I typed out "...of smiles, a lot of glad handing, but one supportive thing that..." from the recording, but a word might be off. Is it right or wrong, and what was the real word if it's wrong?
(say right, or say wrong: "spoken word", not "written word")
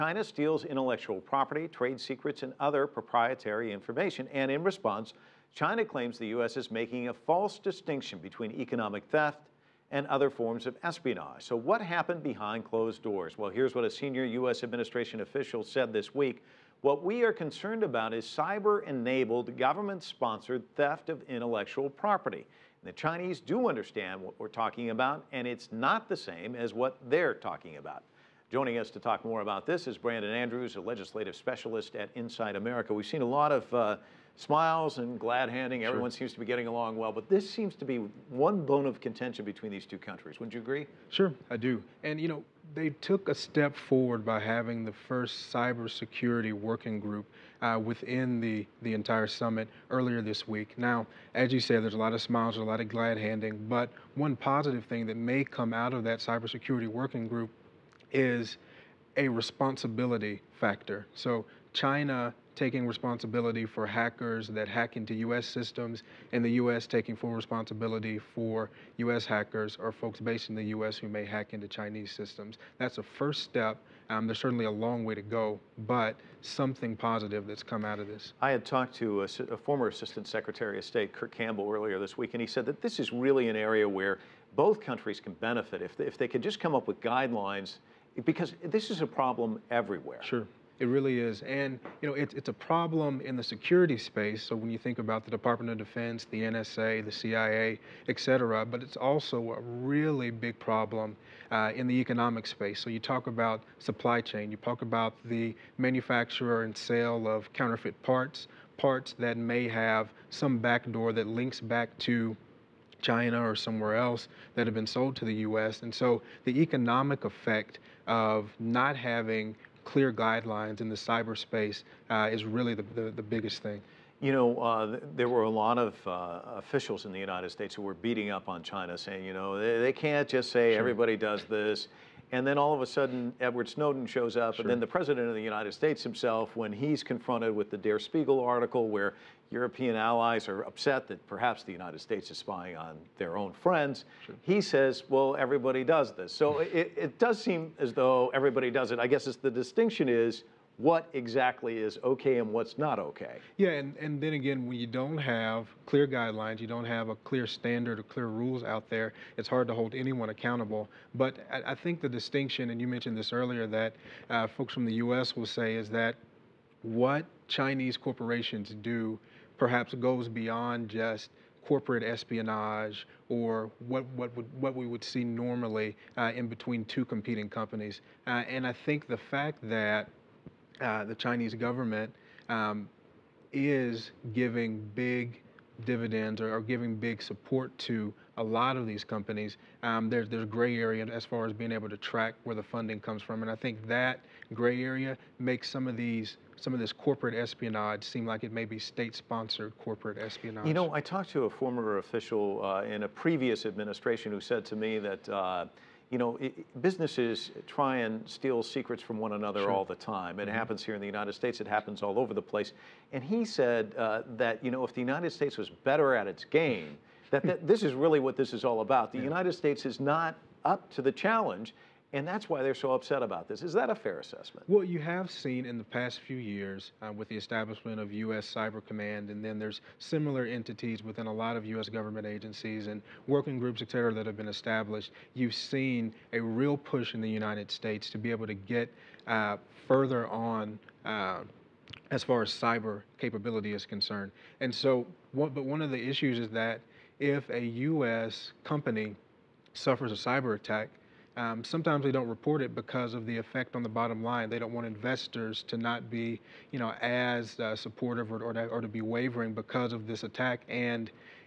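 wrong: "positive", not "supportive".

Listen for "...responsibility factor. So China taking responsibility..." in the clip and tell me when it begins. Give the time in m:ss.
0:59.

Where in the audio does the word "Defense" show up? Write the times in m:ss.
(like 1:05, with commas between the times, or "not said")
1:35.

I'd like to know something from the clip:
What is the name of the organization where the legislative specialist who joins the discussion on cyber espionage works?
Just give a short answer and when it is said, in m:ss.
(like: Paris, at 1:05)
Inside America, at 0:32.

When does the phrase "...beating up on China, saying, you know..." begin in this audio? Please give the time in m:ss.
2:07.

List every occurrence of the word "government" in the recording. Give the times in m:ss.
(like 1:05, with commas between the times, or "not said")
0:19, 3:01, 3:51.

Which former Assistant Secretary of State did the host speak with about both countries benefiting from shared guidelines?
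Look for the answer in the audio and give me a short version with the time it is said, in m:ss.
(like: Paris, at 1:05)
Kurt Campbell, at 1:21.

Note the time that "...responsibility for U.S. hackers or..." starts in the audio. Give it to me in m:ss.
1:07.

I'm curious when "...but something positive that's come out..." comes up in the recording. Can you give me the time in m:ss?
1:15.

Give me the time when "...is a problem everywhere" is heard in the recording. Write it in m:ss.
1:28.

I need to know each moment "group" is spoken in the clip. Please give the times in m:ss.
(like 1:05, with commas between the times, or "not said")
0:47, 0:57, 3:53.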